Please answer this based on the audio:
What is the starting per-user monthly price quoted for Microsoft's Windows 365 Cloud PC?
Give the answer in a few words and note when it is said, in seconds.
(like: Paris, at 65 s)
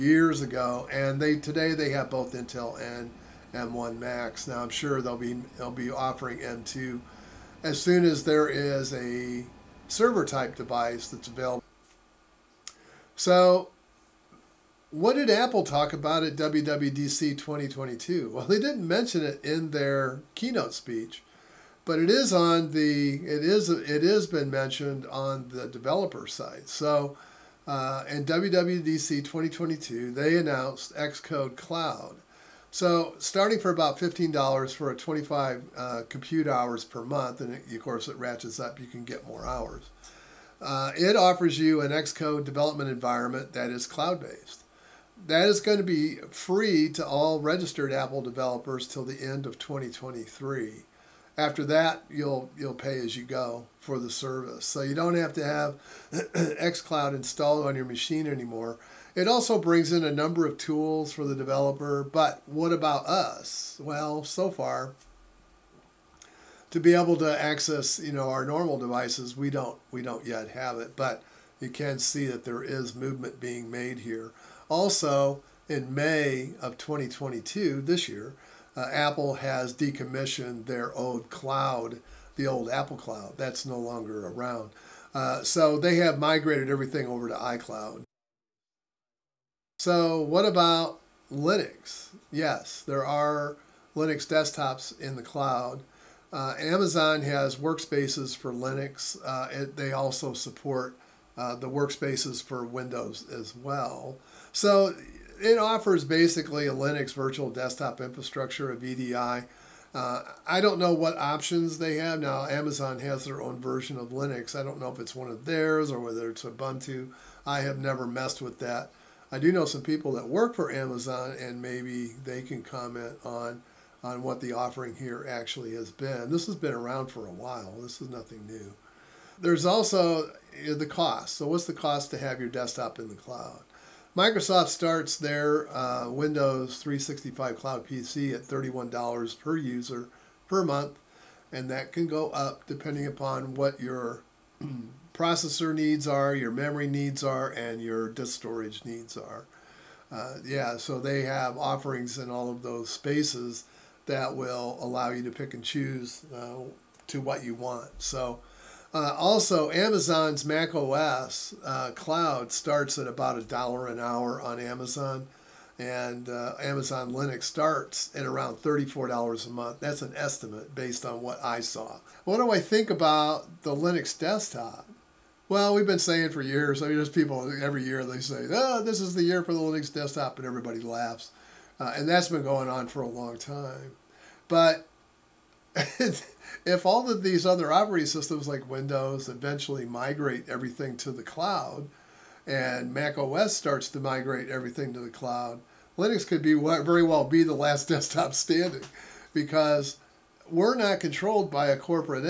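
$31, at 138 s.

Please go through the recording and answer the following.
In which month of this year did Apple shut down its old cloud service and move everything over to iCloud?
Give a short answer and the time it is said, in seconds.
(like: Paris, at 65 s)
May, at 75 s.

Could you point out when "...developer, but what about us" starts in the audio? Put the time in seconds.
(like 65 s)
61 s.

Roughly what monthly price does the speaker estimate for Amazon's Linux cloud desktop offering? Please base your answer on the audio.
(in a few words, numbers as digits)
$34.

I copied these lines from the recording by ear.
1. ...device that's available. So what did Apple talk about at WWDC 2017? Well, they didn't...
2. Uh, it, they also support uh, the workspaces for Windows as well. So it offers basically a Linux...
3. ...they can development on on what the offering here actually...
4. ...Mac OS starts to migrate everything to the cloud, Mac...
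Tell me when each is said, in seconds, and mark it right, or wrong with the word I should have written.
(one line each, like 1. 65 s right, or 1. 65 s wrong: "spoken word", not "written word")
1. 10 s wrong: "2022", not "2017"
2. 99 s right
3. 122 s wrong: "comment", not "development"
4. 192 s wrong: "Linux", not "Mac".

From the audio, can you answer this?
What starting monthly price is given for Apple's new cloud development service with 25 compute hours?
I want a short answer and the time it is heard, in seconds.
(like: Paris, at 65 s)
$15, at 33 s.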